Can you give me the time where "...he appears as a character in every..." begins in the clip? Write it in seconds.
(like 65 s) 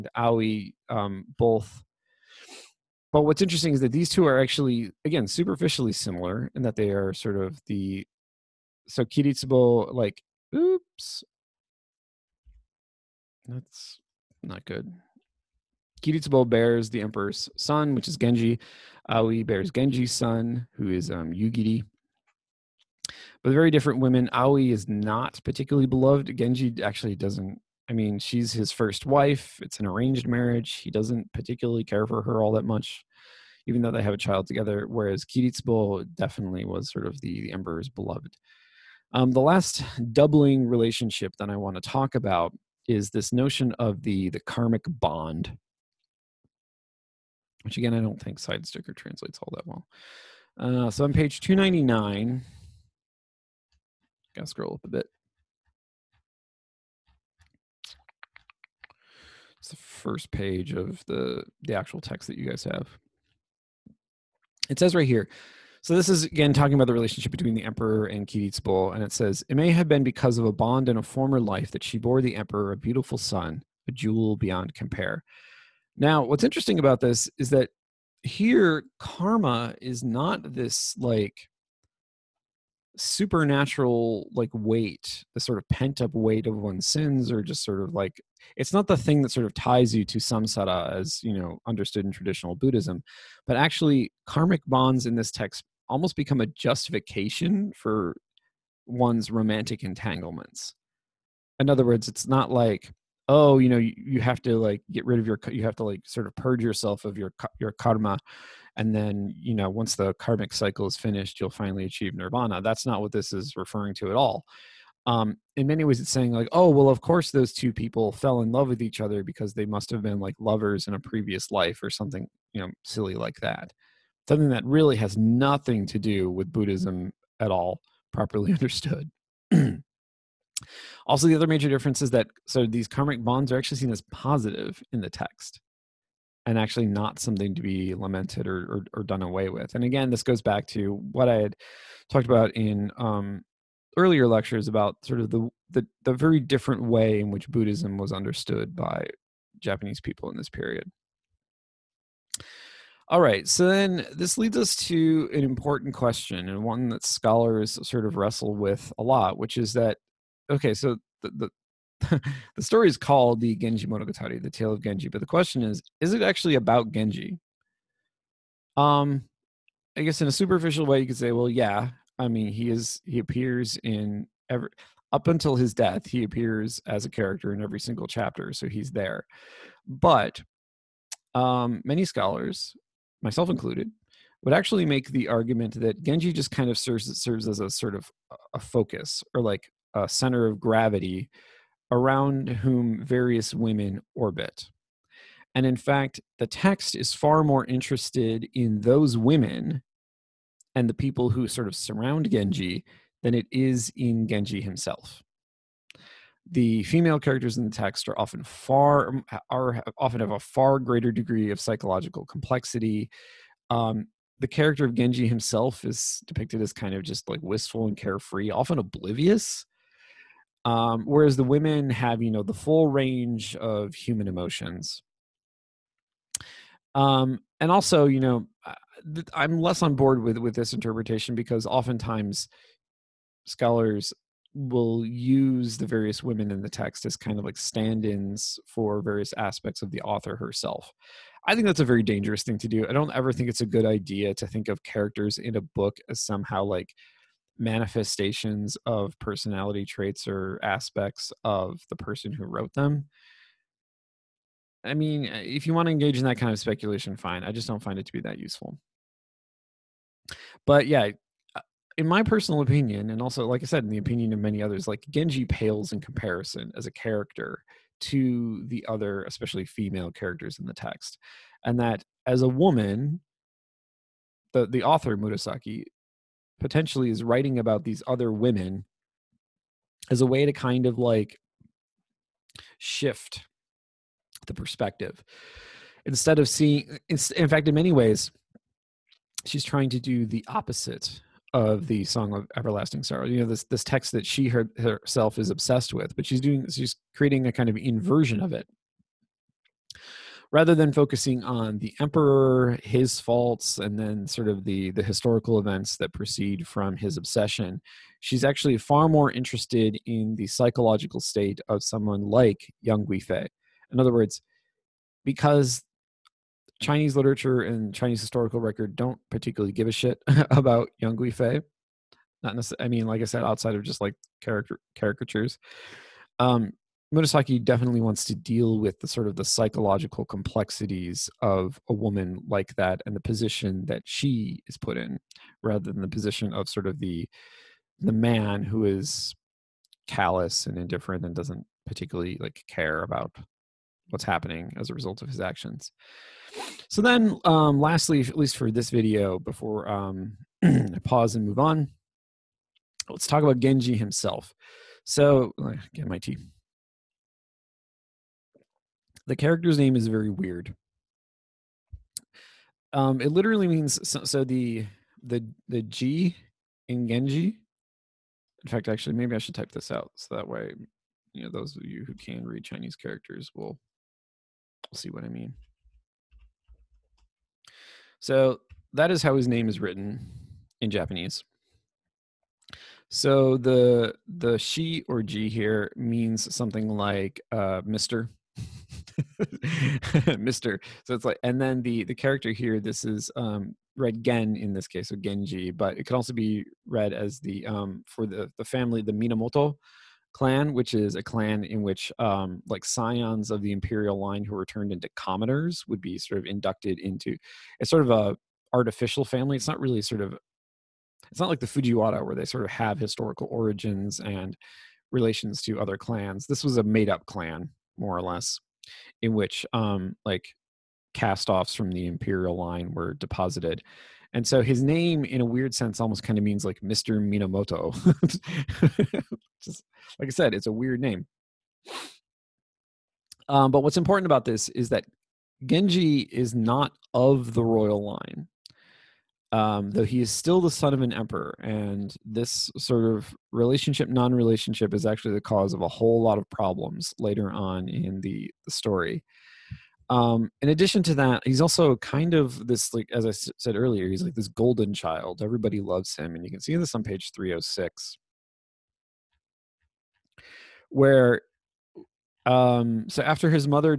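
176 s.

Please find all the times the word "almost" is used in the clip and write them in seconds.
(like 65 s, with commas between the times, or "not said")
95 s, 425 s.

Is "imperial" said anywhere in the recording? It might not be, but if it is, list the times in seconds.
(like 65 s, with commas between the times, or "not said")
403 s, 422 s.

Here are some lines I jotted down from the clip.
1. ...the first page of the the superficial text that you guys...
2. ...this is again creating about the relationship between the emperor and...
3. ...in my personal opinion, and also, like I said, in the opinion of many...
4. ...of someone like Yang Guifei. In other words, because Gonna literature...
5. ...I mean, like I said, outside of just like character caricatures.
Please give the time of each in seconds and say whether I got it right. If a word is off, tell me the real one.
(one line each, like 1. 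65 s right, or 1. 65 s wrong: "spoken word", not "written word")
1. 59 s wrong: "actual", not "superficial"
2. 65 s wrong: "talking", not "creating"
3. 261 s right
4. 311 s wrong: "Chinese", not "Gonna"
5. 322 s right.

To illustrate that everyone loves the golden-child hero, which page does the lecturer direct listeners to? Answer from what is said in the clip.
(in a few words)
306.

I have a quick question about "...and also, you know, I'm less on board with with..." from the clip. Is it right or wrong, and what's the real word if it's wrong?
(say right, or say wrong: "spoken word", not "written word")
right.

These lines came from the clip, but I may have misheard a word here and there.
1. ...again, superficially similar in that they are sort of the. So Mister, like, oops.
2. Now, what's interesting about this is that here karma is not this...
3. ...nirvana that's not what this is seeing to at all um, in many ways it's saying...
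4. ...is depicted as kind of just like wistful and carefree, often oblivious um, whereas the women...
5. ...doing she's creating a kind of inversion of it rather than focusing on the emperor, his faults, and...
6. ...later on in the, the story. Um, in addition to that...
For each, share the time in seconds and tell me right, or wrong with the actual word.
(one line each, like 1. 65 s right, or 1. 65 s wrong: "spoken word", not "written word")
1. 5 s wrong: "Kiritsubo", not "Mister"
2. 75 s right
3. 112 s wrong: "referring", not "seeing"
4. 215 s right
5. 296 s right
6. 447 s right.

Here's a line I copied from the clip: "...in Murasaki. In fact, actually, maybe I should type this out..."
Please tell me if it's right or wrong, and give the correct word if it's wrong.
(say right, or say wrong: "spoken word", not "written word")
wrong: "Genji", not "Murasaki".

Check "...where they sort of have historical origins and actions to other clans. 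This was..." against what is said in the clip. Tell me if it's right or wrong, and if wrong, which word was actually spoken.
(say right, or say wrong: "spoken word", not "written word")
wrong: "relations", not "actions".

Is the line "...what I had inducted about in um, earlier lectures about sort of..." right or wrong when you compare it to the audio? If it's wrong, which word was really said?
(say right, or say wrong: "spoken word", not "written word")
wrong: "talked", not "inducted".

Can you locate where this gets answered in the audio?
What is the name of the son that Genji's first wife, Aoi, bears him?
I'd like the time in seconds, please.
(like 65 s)
21 s.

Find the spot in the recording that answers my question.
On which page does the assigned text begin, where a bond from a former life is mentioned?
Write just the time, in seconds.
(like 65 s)
51 s.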